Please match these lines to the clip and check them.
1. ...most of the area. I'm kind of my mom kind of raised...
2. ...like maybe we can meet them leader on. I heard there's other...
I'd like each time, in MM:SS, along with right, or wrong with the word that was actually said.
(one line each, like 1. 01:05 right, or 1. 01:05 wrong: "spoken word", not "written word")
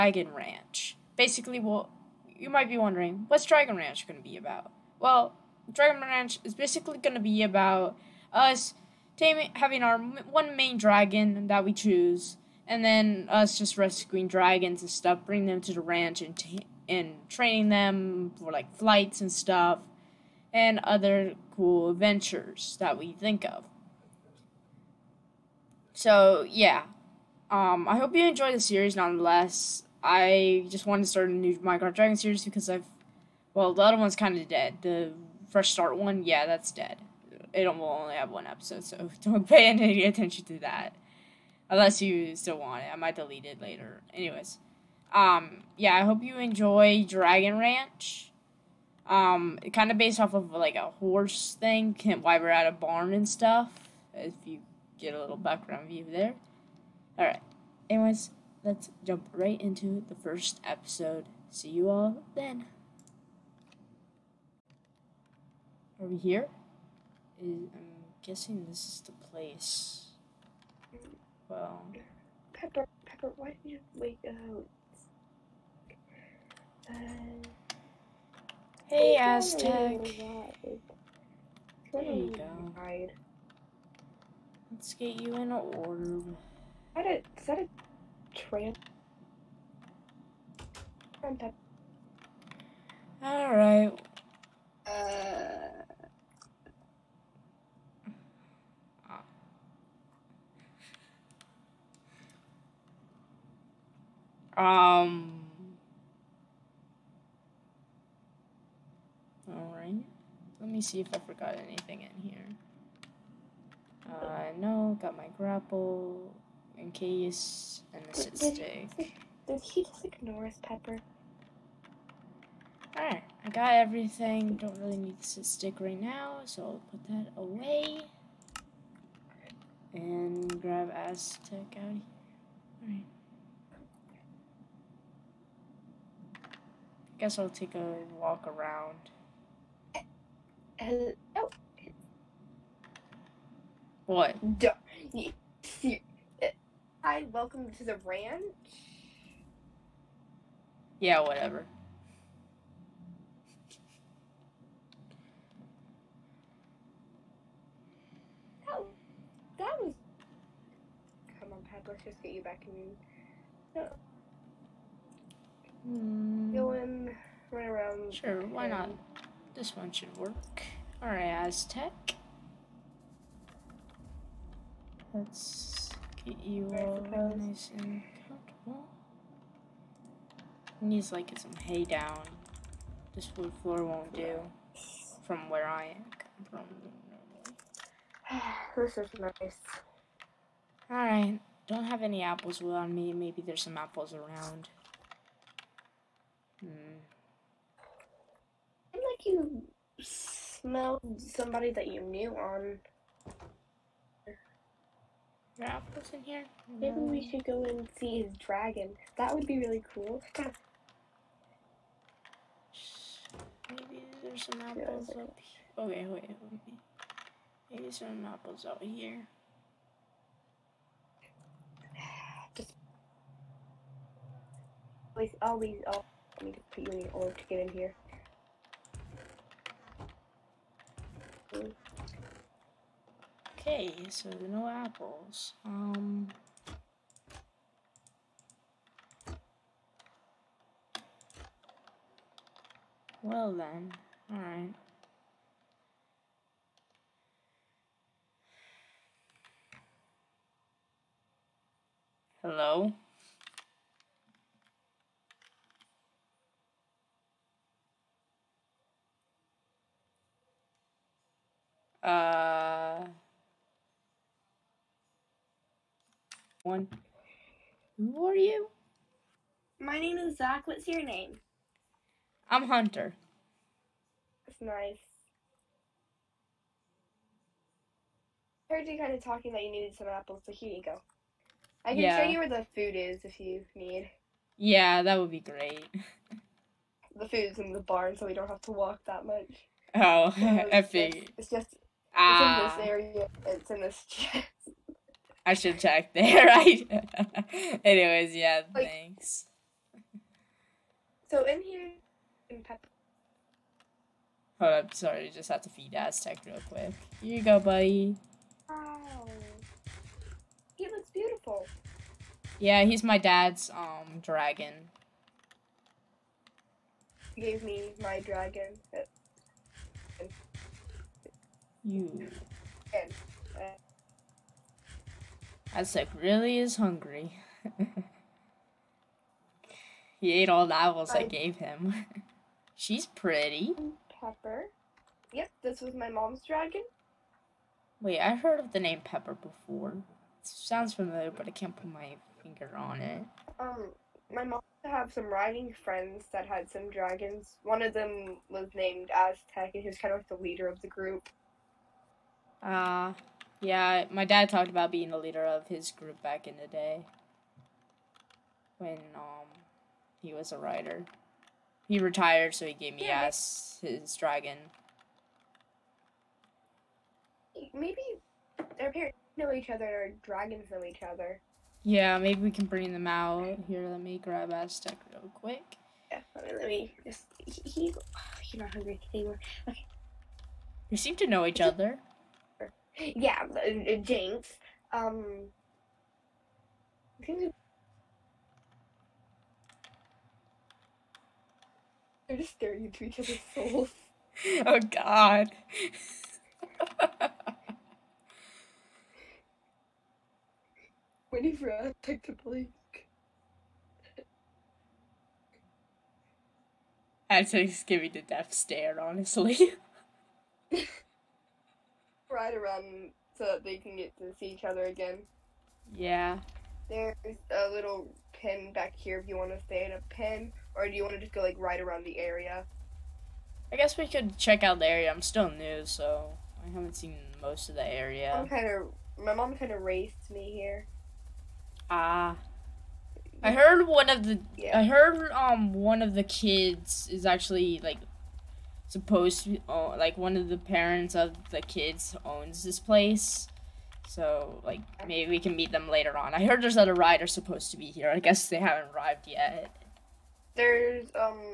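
1. 07:07 right
2. 07:24 wrong: "later", not "leader".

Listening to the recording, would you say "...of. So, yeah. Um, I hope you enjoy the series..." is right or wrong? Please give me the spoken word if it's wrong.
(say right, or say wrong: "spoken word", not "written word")
right.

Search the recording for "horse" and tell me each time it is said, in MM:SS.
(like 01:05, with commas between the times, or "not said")
00:51.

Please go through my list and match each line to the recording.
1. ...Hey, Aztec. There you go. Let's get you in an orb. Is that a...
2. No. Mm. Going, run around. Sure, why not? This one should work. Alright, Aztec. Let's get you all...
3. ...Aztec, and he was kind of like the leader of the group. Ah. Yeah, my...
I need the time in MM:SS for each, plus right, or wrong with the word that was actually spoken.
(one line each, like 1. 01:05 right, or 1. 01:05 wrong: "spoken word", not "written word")
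1. 01:18 right
2. 02:43 right
3. 05:49 right.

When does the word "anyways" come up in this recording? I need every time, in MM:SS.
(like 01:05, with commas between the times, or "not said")
00:44, 00:57, 04:57.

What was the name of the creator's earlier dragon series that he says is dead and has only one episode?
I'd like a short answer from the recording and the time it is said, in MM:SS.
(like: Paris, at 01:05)
Fresh Start, at 00:34.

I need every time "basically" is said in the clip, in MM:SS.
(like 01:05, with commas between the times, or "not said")
00:01, 00:06.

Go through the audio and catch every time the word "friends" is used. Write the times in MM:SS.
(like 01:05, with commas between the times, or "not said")
05:45.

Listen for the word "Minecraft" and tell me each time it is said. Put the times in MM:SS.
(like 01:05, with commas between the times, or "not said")
00:31.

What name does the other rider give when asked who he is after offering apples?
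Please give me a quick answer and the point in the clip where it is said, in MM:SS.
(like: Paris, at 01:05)
Hunter, at 04:32.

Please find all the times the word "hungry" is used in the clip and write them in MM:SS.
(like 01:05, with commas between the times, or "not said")
05:26, 06:18.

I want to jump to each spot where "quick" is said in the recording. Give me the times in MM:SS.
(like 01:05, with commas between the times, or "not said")
05:06, 06:15.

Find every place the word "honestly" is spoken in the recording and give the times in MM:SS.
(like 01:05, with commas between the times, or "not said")
06:49.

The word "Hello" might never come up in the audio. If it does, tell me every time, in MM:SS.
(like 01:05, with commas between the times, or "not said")
04:12.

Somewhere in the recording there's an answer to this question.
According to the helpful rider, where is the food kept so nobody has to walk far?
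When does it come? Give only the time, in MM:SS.
04:47.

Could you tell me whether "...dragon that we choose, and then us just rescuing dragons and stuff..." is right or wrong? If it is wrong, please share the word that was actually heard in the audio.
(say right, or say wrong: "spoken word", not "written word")
right.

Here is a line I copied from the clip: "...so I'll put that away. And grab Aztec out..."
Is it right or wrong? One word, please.
right.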